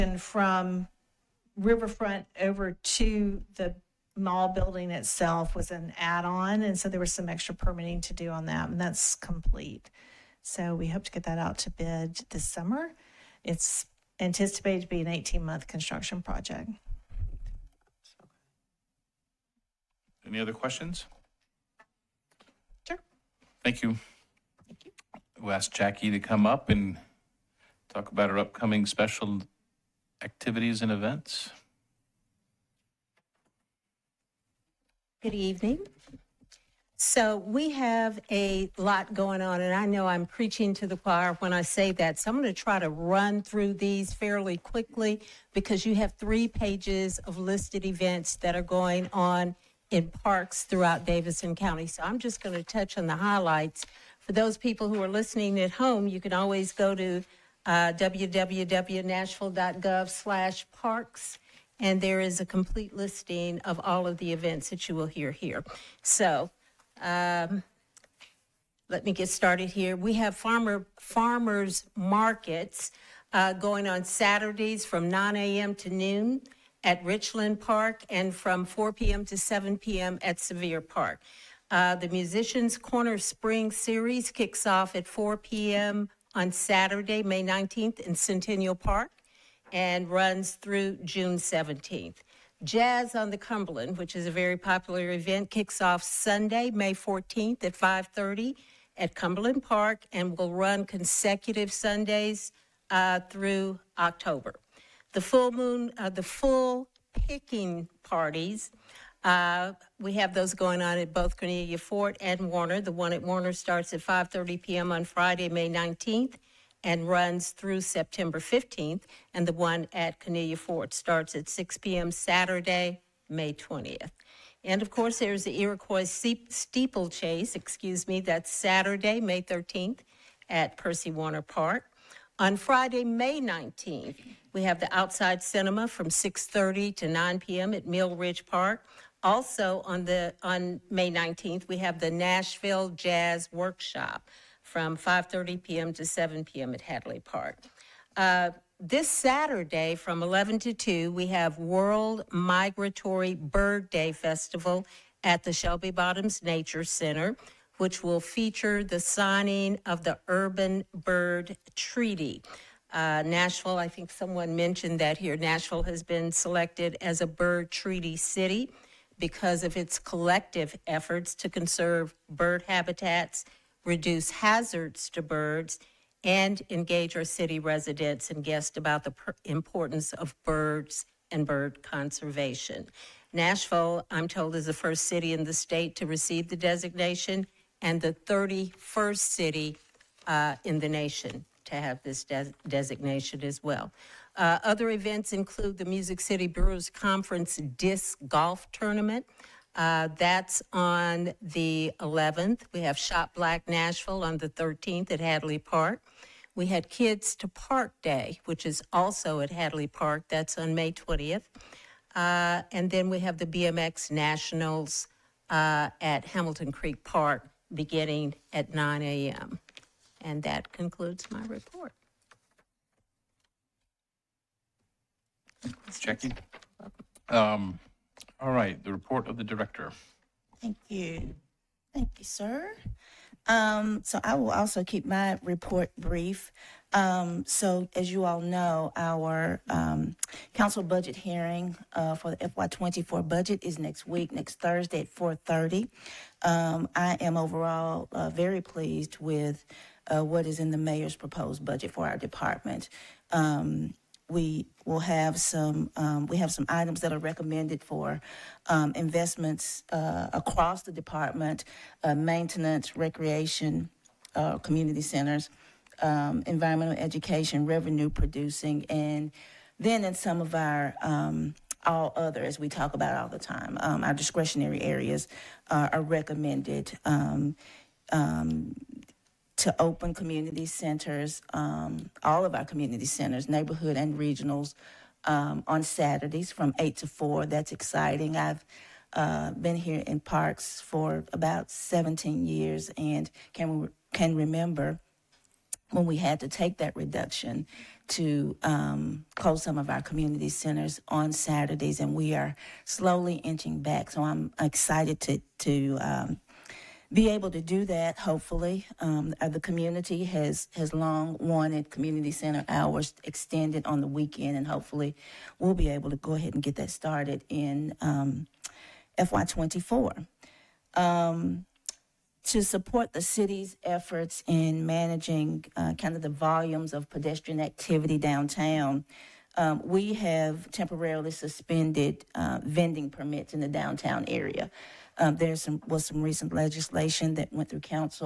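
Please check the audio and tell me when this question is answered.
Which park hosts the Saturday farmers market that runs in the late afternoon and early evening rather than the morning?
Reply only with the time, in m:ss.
1:20.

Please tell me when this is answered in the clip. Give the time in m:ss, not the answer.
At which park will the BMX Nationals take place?
3:36.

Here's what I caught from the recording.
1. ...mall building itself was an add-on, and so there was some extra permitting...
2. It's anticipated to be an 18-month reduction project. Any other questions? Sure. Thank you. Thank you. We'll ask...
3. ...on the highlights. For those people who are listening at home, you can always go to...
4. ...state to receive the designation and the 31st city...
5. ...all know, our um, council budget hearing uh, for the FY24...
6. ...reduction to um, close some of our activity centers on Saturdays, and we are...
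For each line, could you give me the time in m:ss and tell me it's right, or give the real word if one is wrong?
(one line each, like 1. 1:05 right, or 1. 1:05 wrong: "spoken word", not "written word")
1. 0:04 right
2. 0:13 wrong: "construction", not "reduction"
3. 0:52 right
4. 3:05 right
5. 3:58 right
6. 4:56 wrong: "community", not "activity".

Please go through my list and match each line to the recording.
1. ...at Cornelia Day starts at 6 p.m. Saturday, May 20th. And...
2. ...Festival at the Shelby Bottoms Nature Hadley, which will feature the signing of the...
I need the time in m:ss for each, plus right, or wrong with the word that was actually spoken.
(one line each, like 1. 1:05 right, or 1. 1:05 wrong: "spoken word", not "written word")
1. 1:59 wrong: "Fort", not "Day"
2. 2:34 wrong: "Center", not "Hadley".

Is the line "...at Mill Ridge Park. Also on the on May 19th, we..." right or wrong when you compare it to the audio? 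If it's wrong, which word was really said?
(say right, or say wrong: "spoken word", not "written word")
right.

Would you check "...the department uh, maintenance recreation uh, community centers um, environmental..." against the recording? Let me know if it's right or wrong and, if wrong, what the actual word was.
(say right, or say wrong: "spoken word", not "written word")
right.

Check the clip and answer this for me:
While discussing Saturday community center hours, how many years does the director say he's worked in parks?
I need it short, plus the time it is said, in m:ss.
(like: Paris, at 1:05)
17 years, at 4:51.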